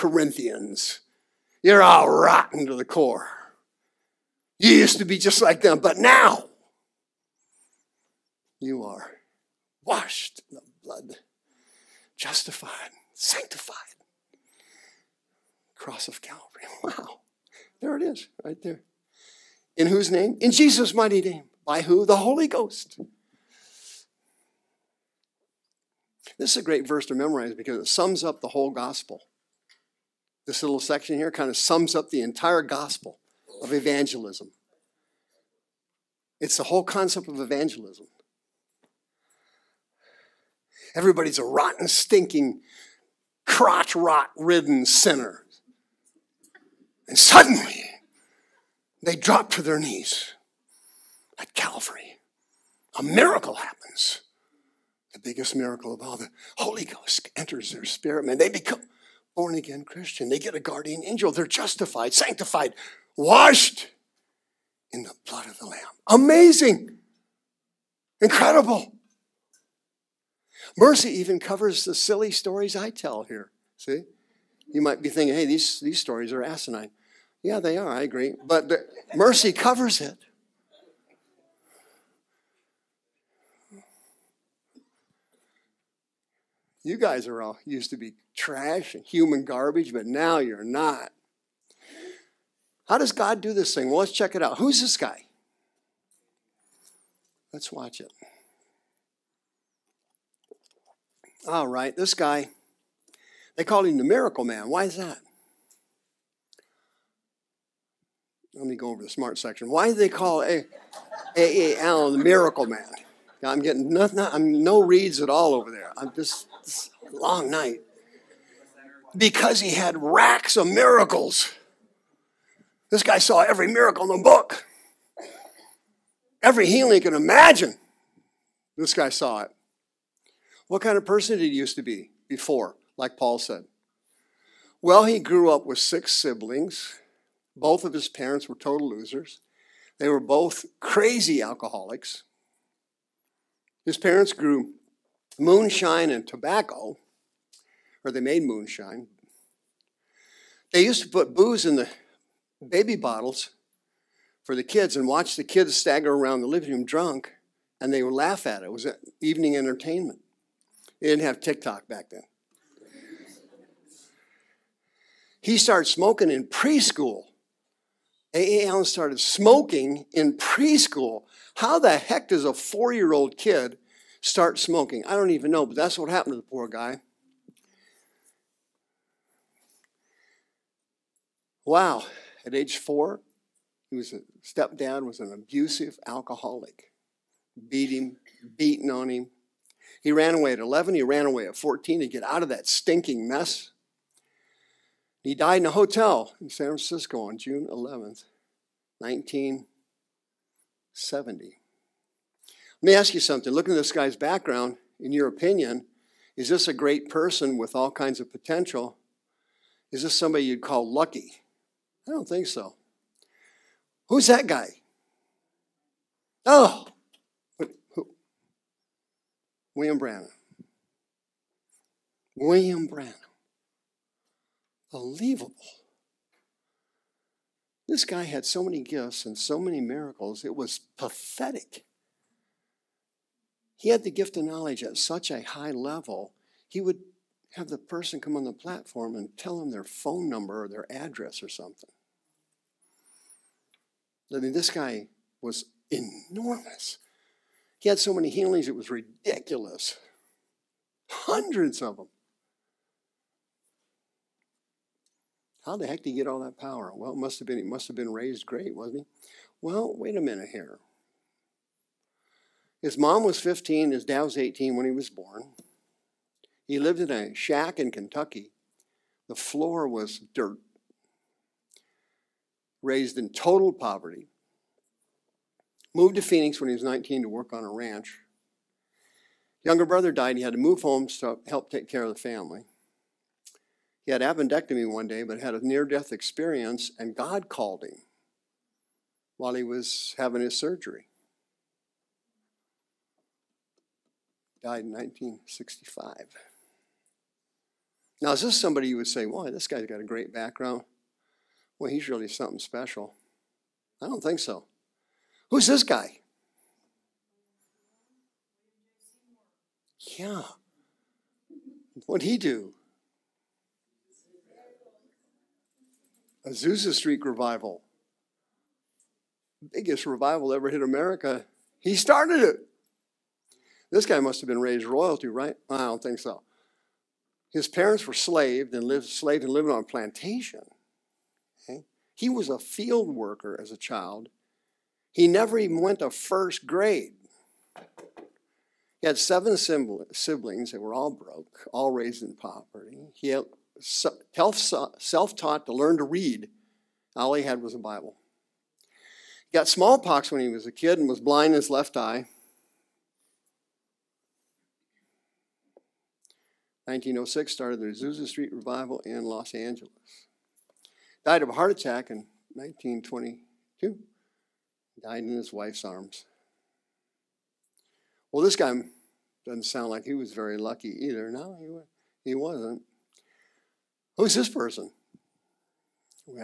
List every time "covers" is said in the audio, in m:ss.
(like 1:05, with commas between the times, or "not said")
1:11, 1:19.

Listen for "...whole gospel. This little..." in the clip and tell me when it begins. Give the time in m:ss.
0:28.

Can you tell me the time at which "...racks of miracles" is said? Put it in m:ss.
2:00.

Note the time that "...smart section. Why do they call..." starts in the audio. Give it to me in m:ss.
1:49.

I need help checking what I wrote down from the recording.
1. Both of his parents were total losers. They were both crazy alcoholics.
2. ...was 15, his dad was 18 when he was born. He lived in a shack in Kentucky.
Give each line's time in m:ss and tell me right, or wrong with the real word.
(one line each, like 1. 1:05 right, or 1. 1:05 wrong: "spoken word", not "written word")
1. 2:17 right
2. 4:23 right.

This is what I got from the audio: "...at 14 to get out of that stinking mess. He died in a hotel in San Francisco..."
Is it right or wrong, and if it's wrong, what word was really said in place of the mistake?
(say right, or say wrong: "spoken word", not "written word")
right.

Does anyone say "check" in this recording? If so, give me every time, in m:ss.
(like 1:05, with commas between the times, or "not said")
1:34.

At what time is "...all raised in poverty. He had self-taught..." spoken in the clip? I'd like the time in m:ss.
5:41.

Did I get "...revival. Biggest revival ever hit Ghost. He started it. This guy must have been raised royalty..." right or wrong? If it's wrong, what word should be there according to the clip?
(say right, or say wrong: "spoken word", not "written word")
wrong: "America", not "Ghost".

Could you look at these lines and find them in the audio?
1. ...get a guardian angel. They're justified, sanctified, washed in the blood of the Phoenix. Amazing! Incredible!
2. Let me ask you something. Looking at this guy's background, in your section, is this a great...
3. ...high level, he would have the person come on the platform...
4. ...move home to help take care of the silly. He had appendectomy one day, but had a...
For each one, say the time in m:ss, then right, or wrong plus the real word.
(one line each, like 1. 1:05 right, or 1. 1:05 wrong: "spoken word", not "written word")
1. 1:00 wrong: "Lamb", not "Phoenix"
2. 3:22 wrong: "opinion", not "section"
3. 3:55 right
4. 4:40 wrong: "family", not "silly".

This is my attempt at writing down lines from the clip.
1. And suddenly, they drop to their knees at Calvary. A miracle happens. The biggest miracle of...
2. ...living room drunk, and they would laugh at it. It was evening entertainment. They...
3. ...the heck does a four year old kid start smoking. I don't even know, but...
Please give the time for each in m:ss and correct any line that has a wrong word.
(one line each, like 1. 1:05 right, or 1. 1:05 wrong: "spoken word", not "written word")
1. 0:47 right
2. 2:36 right
3. 2:51 right.